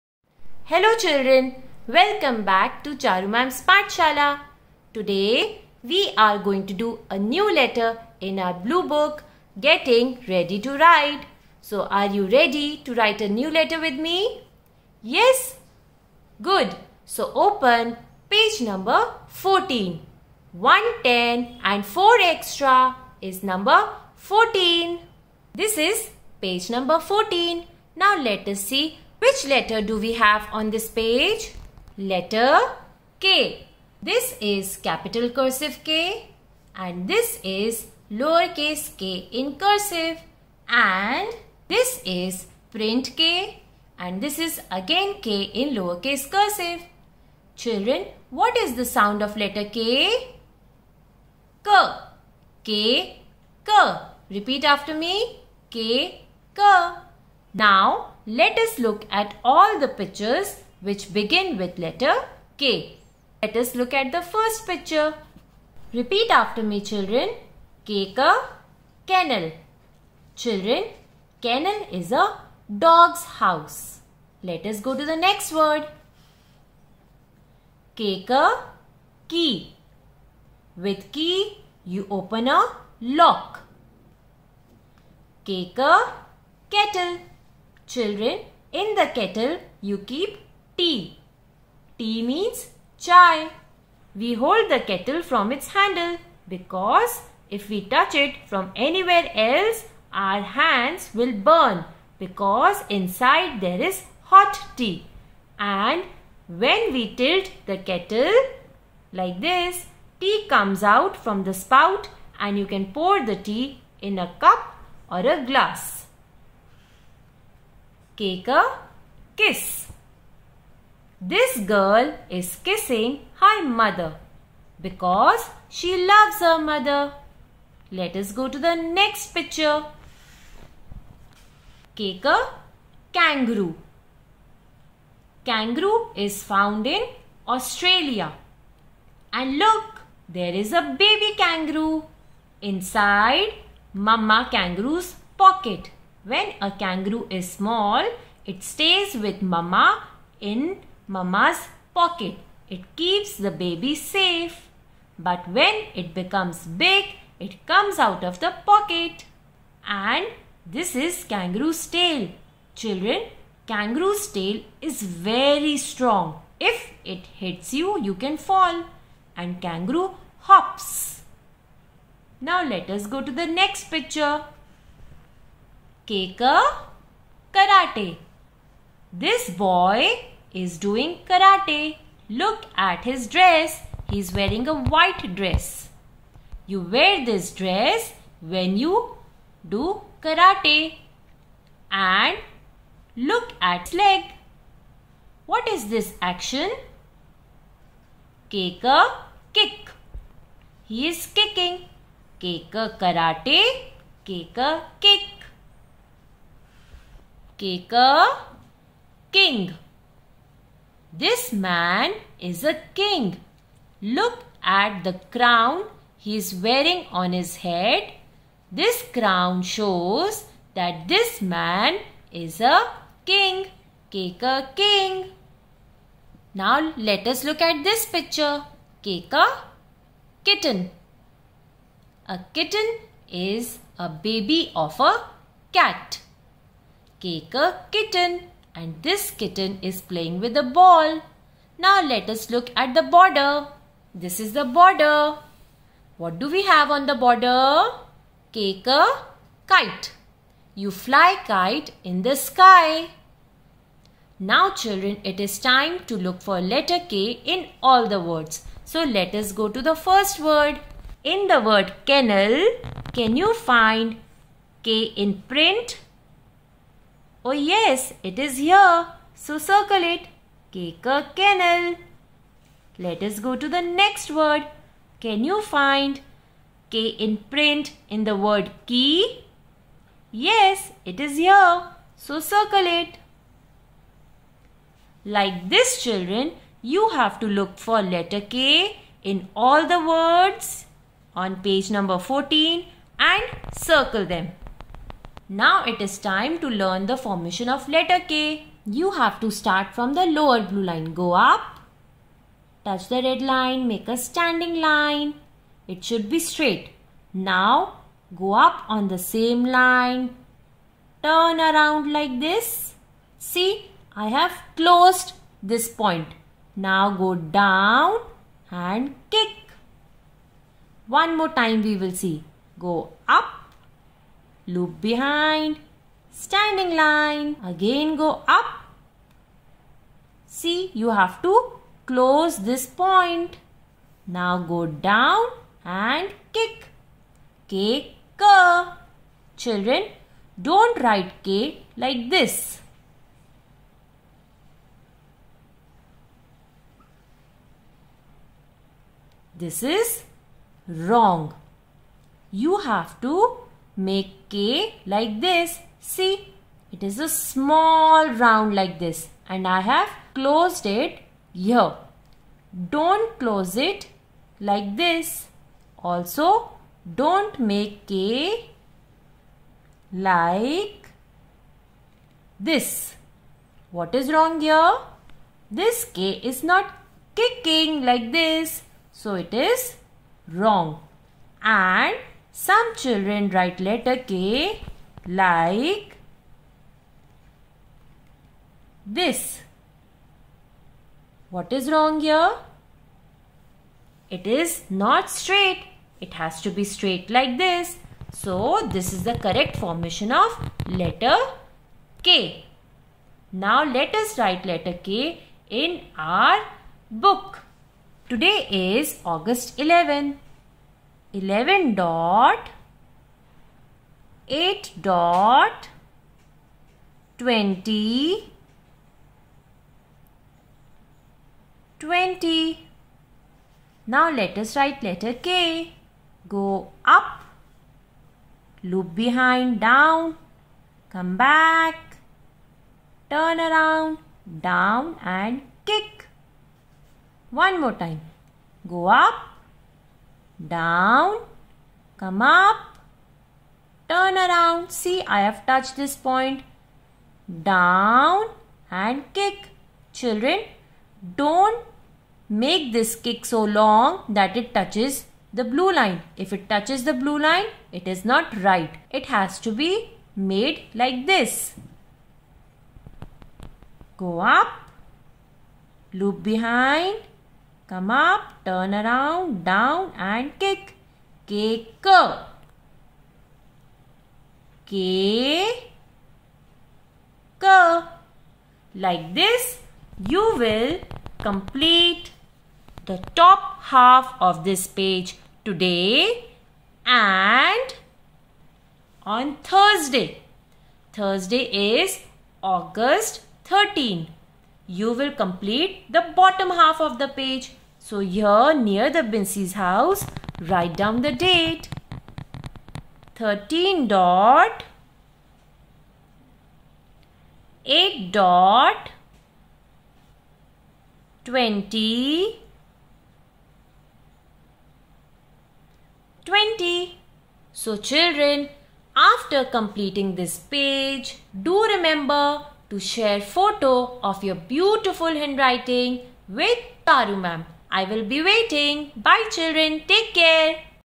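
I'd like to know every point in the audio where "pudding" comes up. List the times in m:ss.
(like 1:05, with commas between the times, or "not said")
not said.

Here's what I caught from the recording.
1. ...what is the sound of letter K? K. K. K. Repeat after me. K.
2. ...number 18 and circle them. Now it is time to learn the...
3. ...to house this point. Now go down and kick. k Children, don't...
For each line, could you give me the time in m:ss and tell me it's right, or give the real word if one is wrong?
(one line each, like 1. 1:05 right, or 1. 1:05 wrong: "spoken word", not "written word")
1. 0:48 right
2. 4:51 wrong: "14", not "18"
3. 5:31 wrong: "close", not "house".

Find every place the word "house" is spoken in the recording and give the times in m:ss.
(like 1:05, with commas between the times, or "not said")
1:13, 8:19.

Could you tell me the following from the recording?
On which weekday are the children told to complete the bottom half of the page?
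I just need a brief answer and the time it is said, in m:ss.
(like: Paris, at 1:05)
Thursday, at 8:09.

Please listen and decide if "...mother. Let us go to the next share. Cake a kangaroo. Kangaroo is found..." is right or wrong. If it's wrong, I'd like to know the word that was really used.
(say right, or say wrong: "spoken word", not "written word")
wrong: "picture", not "share".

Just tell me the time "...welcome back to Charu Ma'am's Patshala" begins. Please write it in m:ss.
0:01.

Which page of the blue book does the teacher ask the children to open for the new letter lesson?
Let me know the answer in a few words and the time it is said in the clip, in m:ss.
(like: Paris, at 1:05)
14, at 0:23.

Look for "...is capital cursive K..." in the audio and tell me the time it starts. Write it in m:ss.
0:34.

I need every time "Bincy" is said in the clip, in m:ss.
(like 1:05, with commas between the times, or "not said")
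8:19.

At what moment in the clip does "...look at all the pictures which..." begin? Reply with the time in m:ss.
0:58.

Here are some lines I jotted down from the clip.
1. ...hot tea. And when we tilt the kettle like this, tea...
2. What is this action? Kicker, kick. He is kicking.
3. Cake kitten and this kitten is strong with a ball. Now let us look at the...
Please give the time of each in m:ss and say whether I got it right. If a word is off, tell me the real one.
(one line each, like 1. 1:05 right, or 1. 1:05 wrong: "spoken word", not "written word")
1. 1:44 right
2. 3:15 right
3. 3:57 wrong: "playing", not "strong".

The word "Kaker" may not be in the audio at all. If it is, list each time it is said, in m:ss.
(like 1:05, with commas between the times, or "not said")
1:07, 1:17, 1:25.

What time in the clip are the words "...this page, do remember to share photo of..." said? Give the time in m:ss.
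8:40.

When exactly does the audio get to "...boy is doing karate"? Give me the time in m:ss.
2:59.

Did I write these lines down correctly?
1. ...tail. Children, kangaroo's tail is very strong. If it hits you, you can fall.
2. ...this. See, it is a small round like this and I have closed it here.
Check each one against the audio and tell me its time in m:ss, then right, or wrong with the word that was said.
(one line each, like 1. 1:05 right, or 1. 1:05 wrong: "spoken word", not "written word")
1. 2:41 right
2. 5:55 right.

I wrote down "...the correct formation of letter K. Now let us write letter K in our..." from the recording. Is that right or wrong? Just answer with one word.
right.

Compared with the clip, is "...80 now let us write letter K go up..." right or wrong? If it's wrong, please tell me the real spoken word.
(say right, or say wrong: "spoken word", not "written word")
wrong: "20", not "80".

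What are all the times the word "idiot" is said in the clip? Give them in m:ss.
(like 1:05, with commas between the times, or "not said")
not said.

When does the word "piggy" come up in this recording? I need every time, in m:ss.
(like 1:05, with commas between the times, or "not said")
not said.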